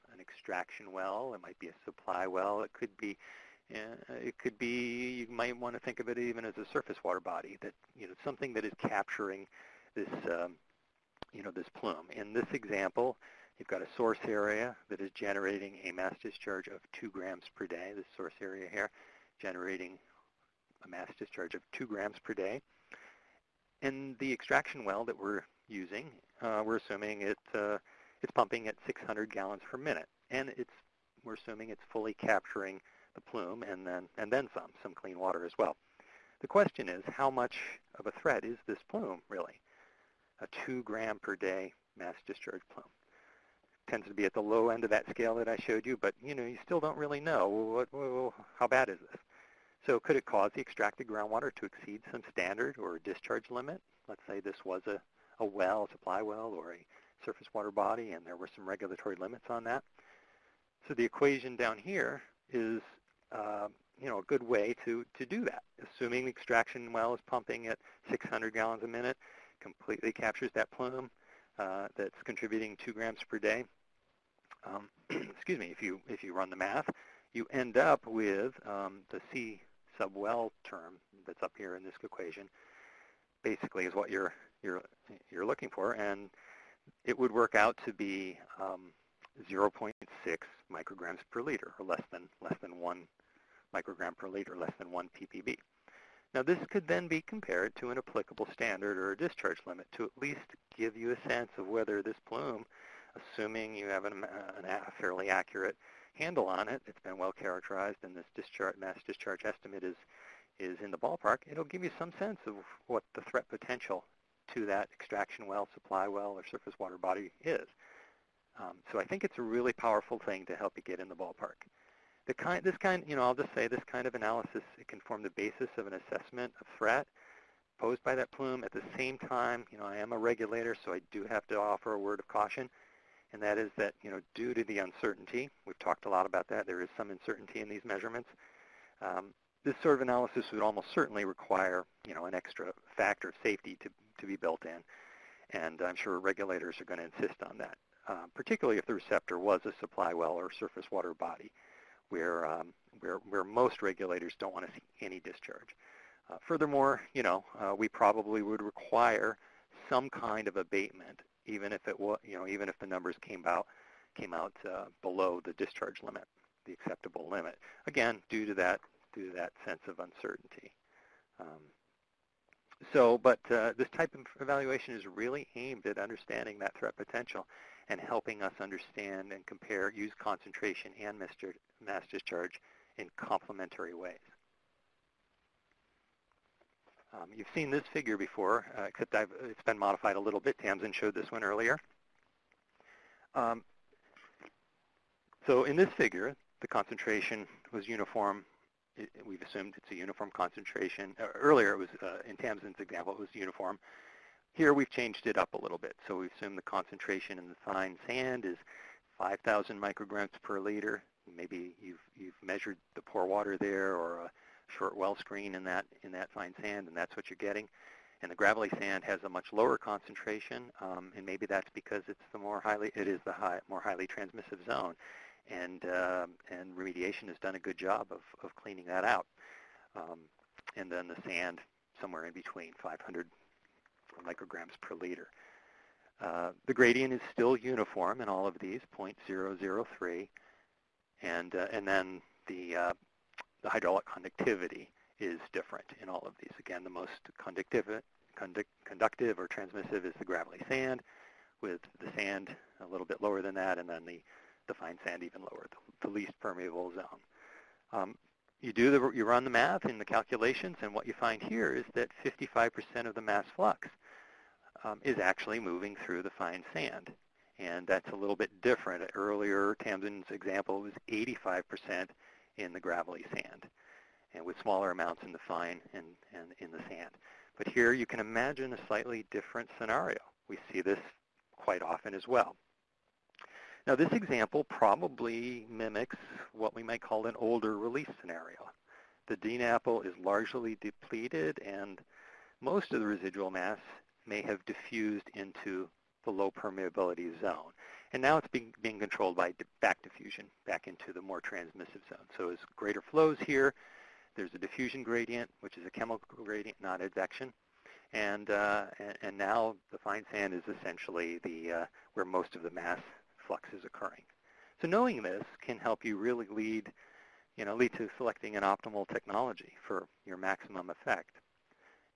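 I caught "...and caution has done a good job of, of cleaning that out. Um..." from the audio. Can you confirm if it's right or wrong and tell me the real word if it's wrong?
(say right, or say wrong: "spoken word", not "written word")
wrong: "remediation", not "caution".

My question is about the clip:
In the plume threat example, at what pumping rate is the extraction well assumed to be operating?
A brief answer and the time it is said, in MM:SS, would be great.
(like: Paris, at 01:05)
600 gallons per minute, at 00:28.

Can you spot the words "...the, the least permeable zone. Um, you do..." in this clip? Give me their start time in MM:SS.
04:15.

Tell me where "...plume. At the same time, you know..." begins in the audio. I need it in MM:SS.
02:08.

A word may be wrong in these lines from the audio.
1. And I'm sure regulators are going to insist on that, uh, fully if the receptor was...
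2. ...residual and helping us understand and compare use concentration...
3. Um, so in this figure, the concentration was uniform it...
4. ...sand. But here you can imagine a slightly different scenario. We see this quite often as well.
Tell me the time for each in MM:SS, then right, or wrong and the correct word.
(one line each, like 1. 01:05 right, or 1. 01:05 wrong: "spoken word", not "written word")
1. 02:25 wrong: "particularly", not "fully"
2. 02:56 wrong: "potential", not "residual"
3. 03:13 right
4. 04:36 right.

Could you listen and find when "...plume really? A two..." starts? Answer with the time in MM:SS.
00:38.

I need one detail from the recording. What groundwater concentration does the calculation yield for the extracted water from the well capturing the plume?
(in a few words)
0.6 micrograms per liter.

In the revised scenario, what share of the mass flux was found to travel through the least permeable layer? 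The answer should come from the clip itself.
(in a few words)
55%.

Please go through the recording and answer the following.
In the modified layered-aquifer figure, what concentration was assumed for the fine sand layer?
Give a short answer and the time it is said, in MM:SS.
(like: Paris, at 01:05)
5,000 micrograms per liter, at 03:29.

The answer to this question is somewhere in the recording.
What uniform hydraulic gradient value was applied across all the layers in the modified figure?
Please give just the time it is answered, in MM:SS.
03:58.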